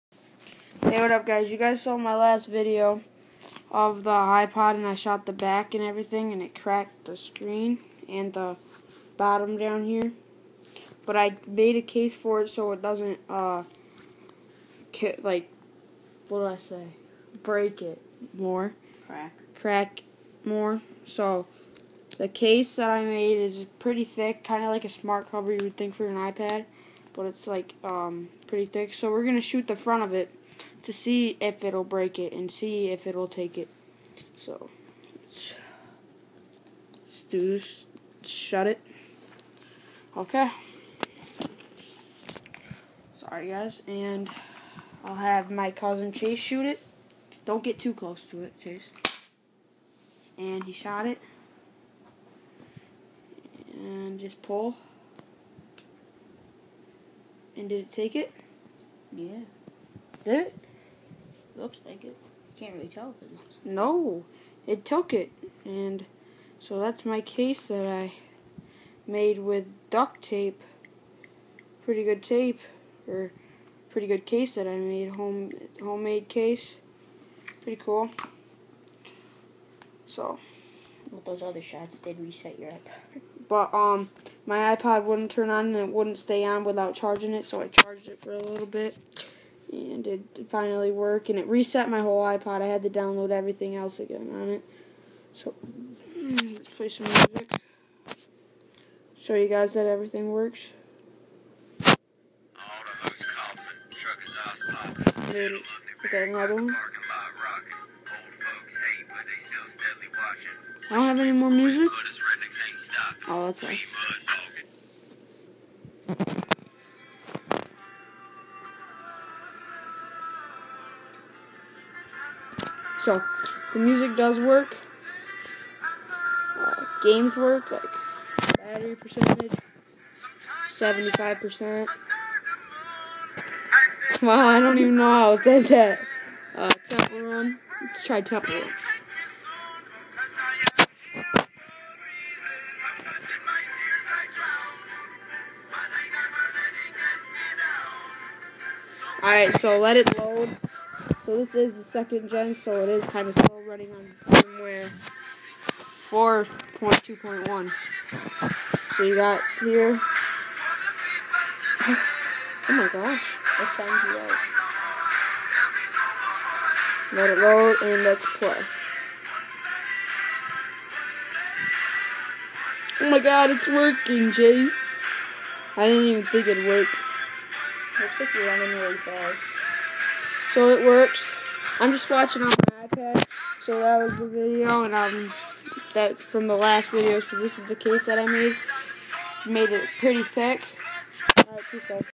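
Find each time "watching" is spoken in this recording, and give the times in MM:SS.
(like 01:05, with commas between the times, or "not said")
03:02.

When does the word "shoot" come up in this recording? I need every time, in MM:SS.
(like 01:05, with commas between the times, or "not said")
00:29, 00:46.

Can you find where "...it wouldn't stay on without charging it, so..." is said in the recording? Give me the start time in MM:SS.
01:25.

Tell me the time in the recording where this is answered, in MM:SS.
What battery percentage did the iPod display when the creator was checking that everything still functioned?
02:10.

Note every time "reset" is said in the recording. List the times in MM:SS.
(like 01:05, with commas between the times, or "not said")
01:22, 01:31.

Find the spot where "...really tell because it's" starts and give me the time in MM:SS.
01:02.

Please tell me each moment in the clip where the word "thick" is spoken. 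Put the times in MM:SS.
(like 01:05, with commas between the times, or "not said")
00:24, 00:28, 03:10.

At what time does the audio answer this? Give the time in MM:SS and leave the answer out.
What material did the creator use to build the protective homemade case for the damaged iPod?
01:09.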